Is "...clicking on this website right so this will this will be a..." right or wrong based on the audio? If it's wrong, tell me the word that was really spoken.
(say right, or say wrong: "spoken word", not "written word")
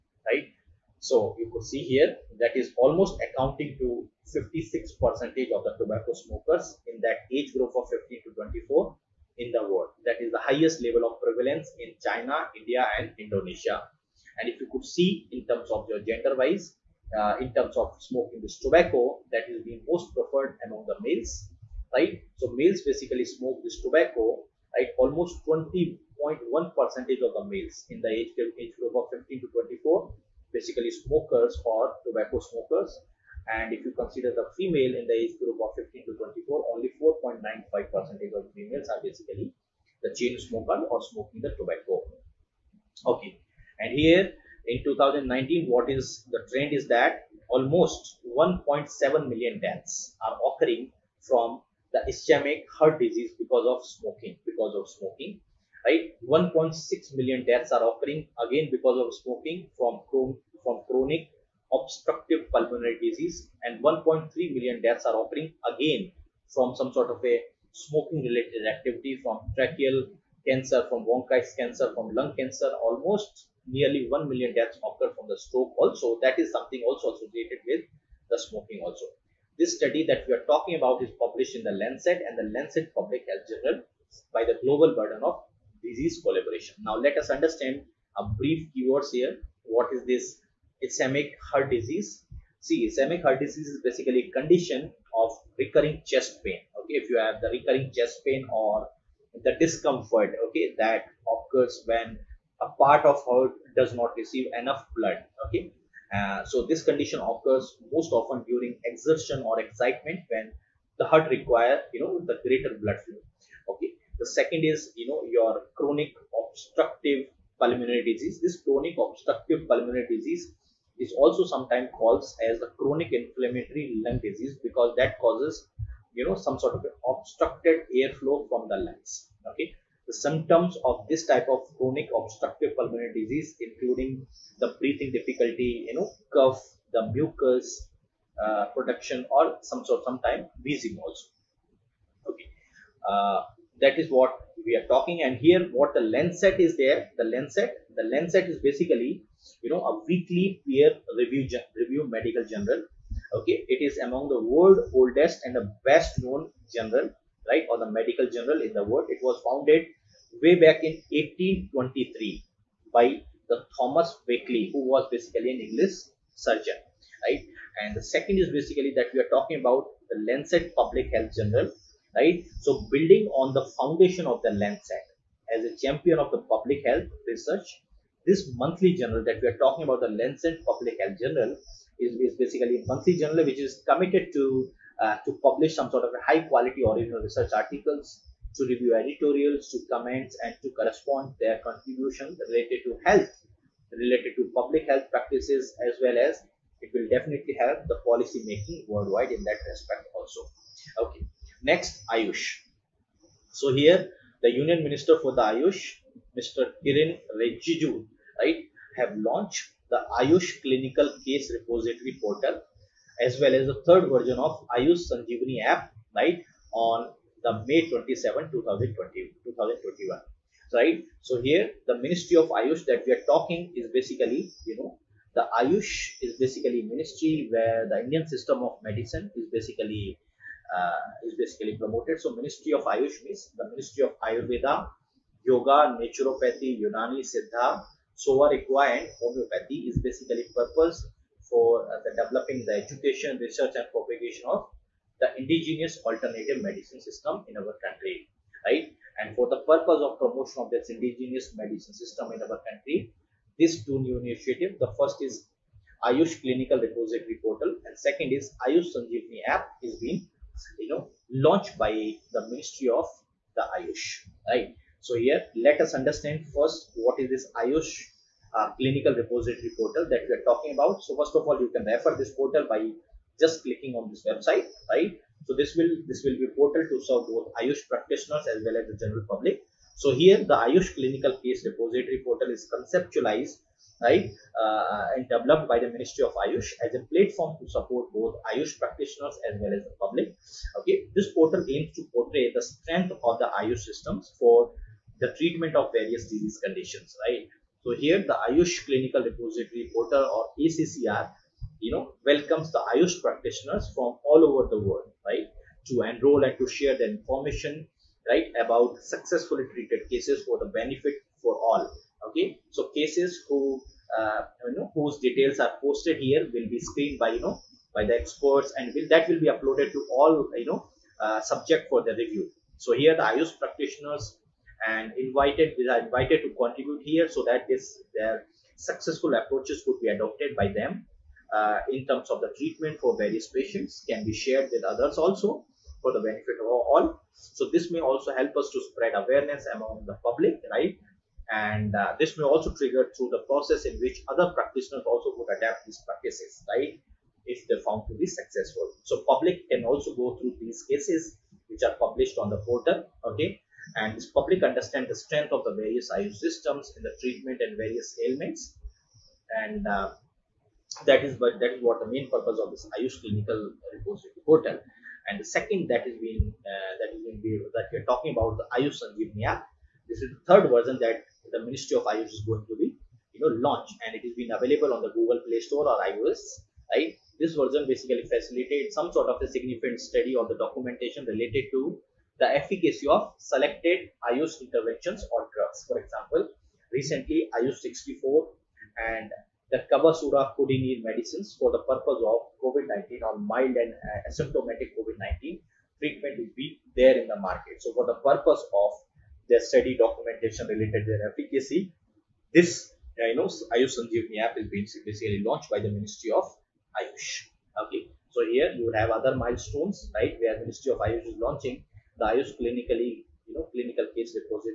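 right.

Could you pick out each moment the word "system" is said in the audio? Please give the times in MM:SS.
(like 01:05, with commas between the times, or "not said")
03:48, 04:07, 04:11, 04:53, 05:56.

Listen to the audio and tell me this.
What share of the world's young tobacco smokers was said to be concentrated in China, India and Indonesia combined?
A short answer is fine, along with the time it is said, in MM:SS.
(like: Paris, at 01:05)
56%, at 00:04.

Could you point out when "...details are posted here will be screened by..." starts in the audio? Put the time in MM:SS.
05:15.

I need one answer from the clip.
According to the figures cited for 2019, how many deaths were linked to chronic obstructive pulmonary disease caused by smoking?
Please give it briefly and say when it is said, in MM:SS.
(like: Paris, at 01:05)
1.6 million, at 00:56.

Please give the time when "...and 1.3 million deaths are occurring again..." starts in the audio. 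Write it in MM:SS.
01:03.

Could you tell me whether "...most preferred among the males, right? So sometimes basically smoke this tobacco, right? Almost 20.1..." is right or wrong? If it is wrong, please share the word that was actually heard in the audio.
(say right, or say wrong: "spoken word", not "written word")
wrong: "males", not "sometimes".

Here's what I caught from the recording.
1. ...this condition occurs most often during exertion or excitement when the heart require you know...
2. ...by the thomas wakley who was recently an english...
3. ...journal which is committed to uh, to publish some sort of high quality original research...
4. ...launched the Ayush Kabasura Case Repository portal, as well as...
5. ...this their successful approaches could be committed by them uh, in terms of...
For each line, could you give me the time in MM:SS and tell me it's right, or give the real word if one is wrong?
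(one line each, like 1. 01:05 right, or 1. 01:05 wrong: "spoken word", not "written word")
1. 01:46 right
2. 02:42 wrong: "basically", not "recently"
3. 03:03 right
4. 03:29 wrong: "Clinical", not "Kabasura"
5. 05:27 wrong: "adopted", not "committed".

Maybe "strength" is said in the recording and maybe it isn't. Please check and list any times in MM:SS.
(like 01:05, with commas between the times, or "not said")
04:52, 05:55.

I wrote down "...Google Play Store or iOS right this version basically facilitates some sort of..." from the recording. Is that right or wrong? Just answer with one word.
right.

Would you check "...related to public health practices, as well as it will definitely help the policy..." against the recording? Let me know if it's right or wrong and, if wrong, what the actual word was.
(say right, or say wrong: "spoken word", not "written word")
right.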